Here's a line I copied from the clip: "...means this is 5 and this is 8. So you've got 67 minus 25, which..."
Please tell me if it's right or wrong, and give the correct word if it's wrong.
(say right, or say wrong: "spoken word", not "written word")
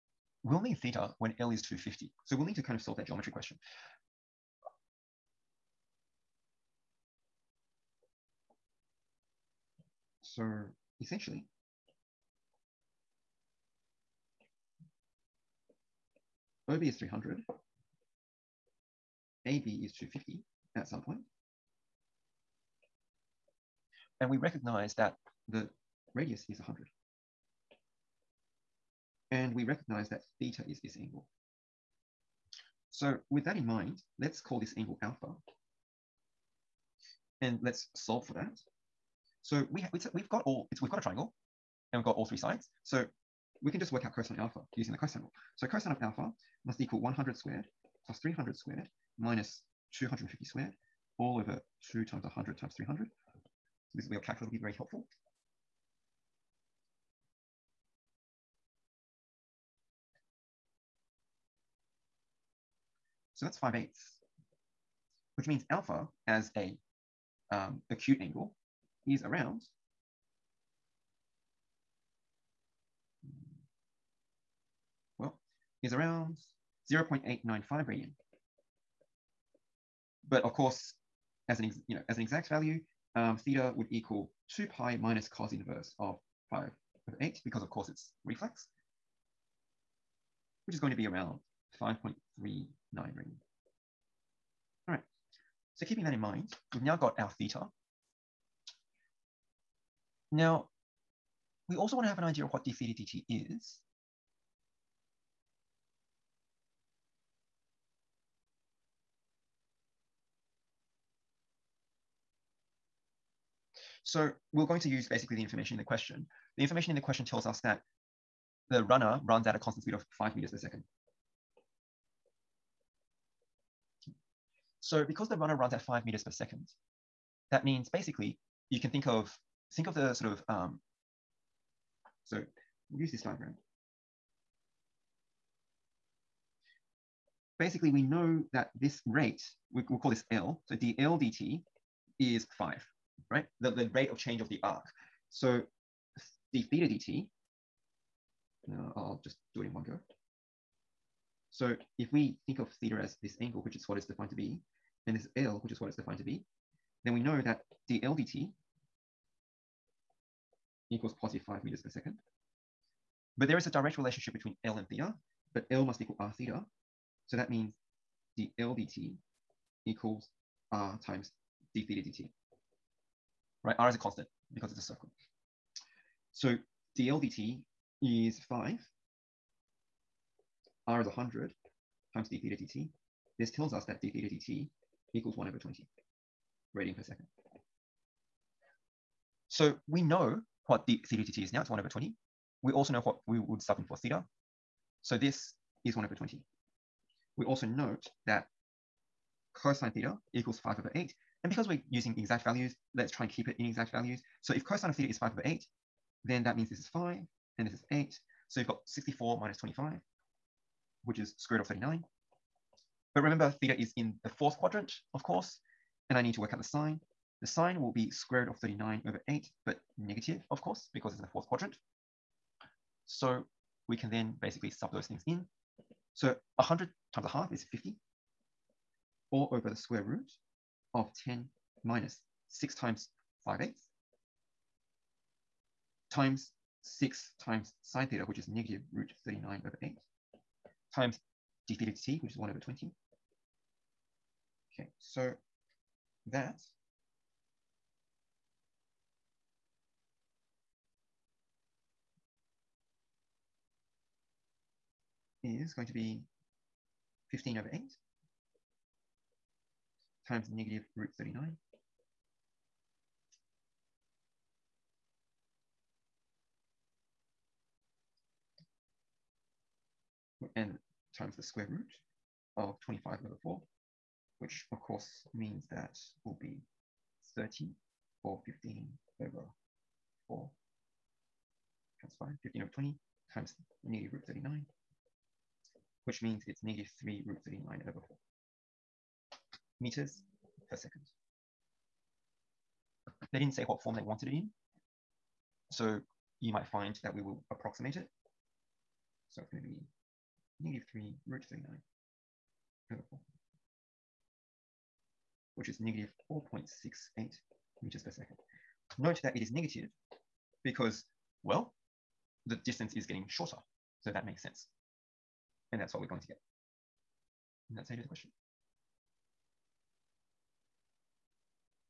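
wrong: "64", not "67".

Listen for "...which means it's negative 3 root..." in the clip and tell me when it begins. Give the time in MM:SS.
04:46.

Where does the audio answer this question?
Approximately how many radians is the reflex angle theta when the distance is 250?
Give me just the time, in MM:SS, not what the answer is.
01:31.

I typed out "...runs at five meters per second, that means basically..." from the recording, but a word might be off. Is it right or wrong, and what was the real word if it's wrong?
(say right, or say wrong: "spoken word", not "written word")
right.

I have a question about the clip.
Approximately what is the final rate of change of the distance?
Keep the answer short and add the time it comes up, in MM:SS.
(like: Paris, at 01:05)
-4.68 meters per second, at 05:05.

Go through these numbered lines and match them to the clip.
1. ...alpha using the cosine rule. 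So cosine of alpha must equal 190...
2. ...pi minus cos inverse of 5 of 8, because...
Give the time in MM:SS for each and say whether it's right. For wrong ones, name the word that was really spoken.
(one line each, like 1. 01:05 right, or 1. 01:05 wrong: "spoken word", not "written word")
1. 00:44 wrong: "100", not "190"
2. 01:24 right.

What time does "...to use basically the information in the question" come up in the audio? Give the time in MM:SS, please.
01:54.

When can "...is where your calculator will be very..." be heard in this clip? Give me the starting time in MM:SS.
00:54.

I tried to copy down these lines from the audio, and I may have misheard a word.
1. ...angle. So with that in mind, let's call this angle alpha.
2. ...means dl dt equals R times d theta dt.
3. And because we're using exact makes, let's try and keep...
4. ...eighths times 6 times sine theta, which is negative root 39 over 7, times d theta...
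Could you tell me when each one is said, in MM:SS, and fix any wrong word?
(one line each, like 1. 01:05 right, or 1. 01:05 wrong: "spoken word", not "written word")
1. 00:30 right
2. 02:47 right
3. 03:21 wrong: "values", not "makes"
4. 03:53 wrong: "8", not "7".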